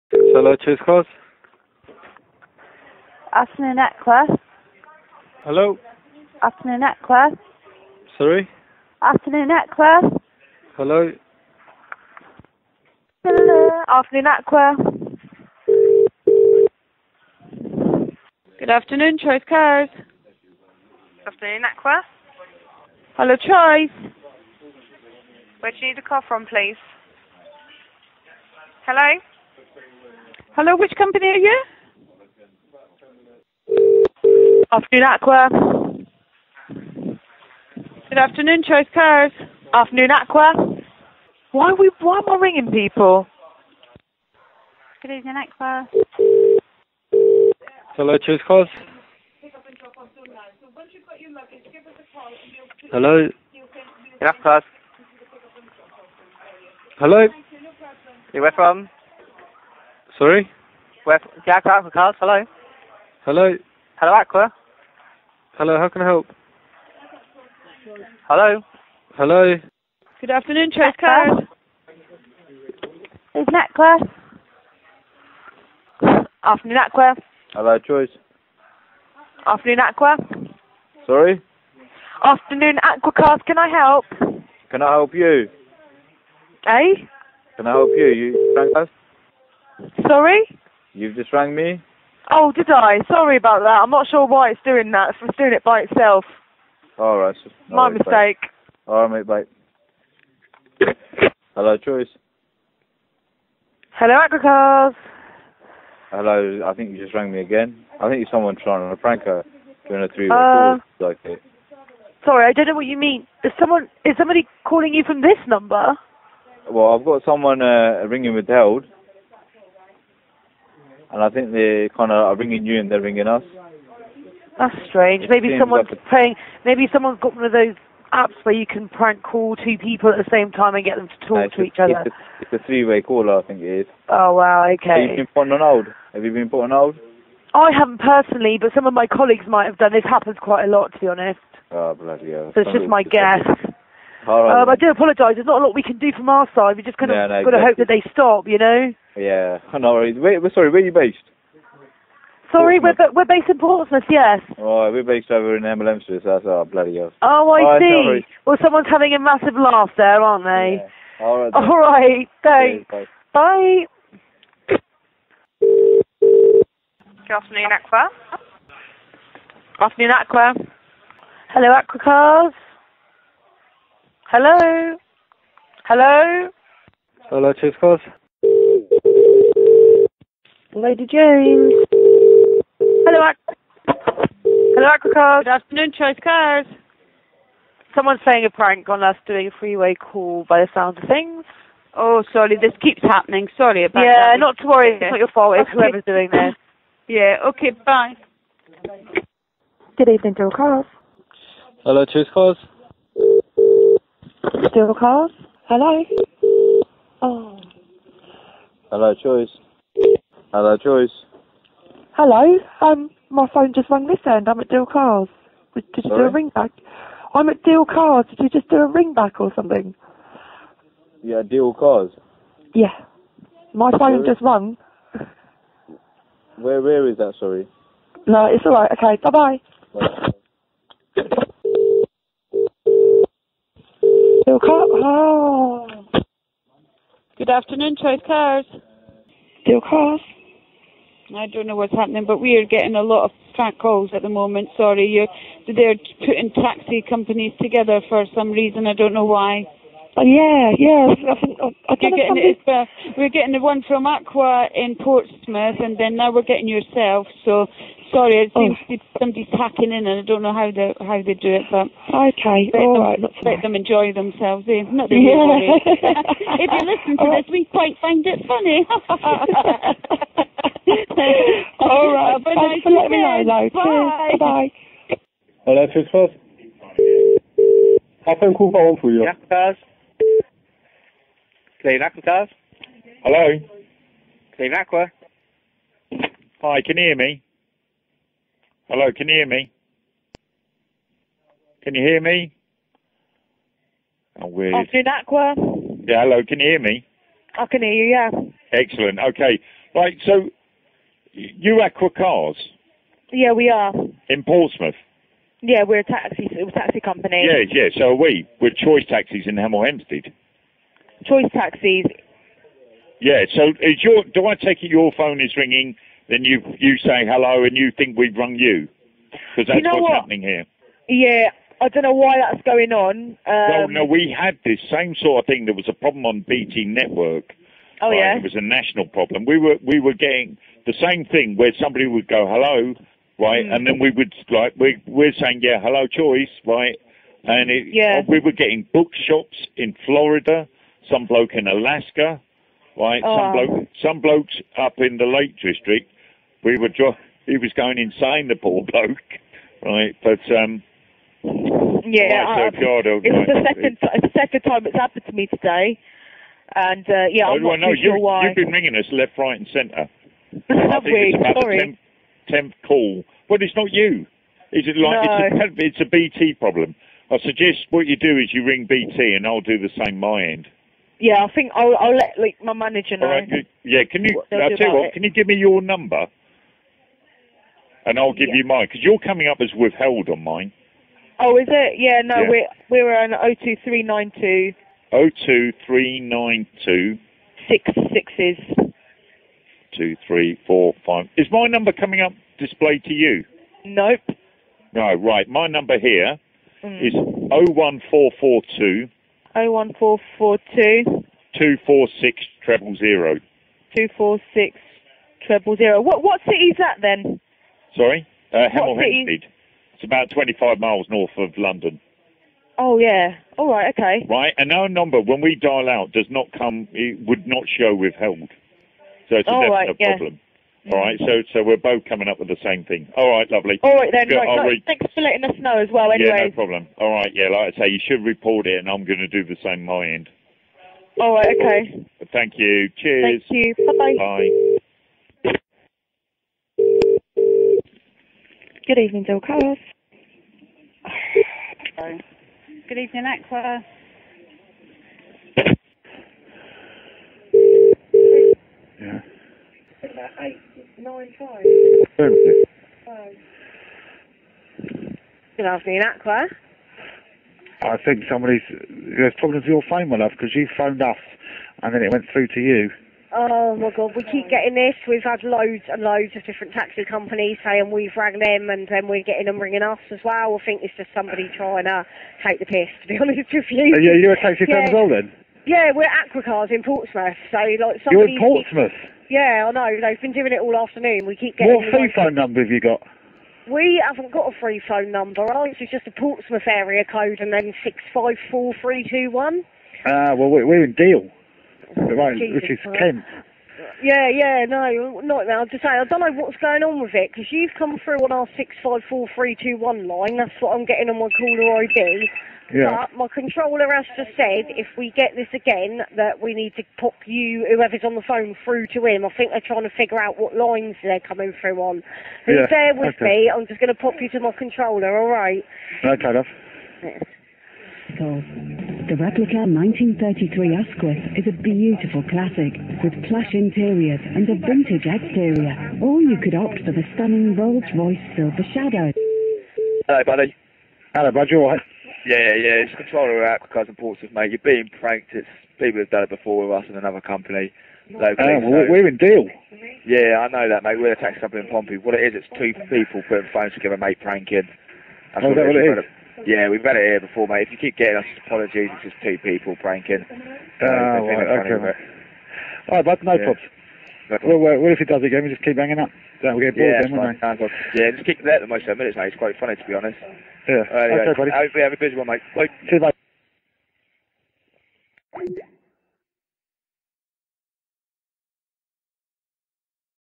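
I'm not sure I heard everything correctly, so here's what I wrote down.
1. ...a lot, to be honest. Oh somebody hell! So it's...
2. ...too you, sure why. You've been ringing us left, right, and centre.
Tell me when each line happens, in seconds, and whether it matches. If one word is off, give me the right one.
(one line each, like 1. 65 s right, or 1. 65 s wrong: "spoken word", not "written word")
1. 140 s wrong: "bloody", not "somebody"
2. 357 s right.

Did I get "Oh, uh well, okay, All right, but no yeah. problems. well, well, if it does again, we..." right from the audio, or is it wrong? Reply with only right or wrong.
right.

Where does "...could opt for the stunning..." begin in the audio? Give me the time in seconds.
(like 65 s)
526 s.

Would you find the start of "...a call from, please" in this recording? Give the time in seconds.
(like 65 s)
25 s.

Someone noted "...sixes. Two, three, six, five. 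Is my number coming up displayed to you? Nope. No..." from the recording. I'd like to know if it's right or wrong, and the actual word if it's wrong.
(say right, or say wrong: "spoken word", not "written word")
wrong: "four", not "six".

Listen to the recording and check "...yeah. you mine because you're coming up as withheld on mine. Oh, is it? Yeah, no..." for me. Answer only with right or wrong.
right.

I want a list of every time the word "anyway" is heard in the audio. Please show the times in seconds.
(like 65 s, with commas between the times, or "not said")
426 s, 560 s.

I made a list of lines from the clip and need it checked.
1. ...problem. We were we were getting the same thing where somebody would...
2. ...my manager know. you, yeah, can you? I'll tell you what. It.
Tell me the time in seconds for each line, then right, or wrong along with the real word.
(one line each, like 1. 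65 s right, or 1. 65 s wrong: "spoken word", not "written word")
1. 329 s right
2. 372 s right.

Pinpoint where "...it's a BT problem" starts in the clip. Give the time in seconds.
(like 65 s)
365 s.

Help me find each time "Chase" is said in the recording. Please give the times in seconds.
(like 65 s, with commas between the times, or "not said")
0 s, 70 s.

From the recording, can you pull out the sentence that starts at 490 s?
Ah, well, we're in Deal right, Jesus which is Kent.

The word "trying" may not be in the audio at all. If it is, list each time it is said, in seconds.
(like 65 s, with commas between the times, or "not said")
108 s, 471 s, 509 s.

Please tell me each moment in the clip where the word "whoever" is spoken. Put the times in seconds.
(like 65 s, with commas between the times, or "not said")
195 s, 507 s.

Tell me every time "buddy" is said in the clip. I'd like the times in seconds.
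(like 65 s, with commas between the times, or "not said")
530 s, 561 s.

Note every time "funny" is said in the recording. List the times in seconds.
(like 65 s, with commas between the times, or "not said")
268 s, 559 s.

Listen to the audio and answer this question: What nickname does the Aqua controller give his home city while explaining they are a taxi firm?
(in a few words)
Pompey.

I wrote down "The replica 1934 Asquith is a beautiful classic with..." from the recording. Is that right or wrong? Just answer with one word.
wrong.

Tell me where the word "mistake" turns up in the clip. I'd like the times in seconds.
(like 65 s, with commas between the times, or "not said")
97 s.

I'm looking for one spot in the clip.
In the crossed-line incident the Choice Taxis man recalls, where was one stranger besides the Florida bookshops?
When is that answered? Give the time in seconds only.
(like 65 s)
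341 s.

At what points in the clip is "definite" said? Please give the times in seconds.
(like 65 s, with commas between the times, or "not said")
419 s.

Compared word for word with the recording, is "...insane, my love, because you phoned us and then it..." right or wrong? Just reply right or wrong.
wrong.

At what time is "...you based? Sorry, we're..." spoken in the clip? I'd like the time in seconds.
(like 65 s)
150 s.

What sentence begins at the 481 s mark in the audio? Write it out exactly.
What free phone number have you got?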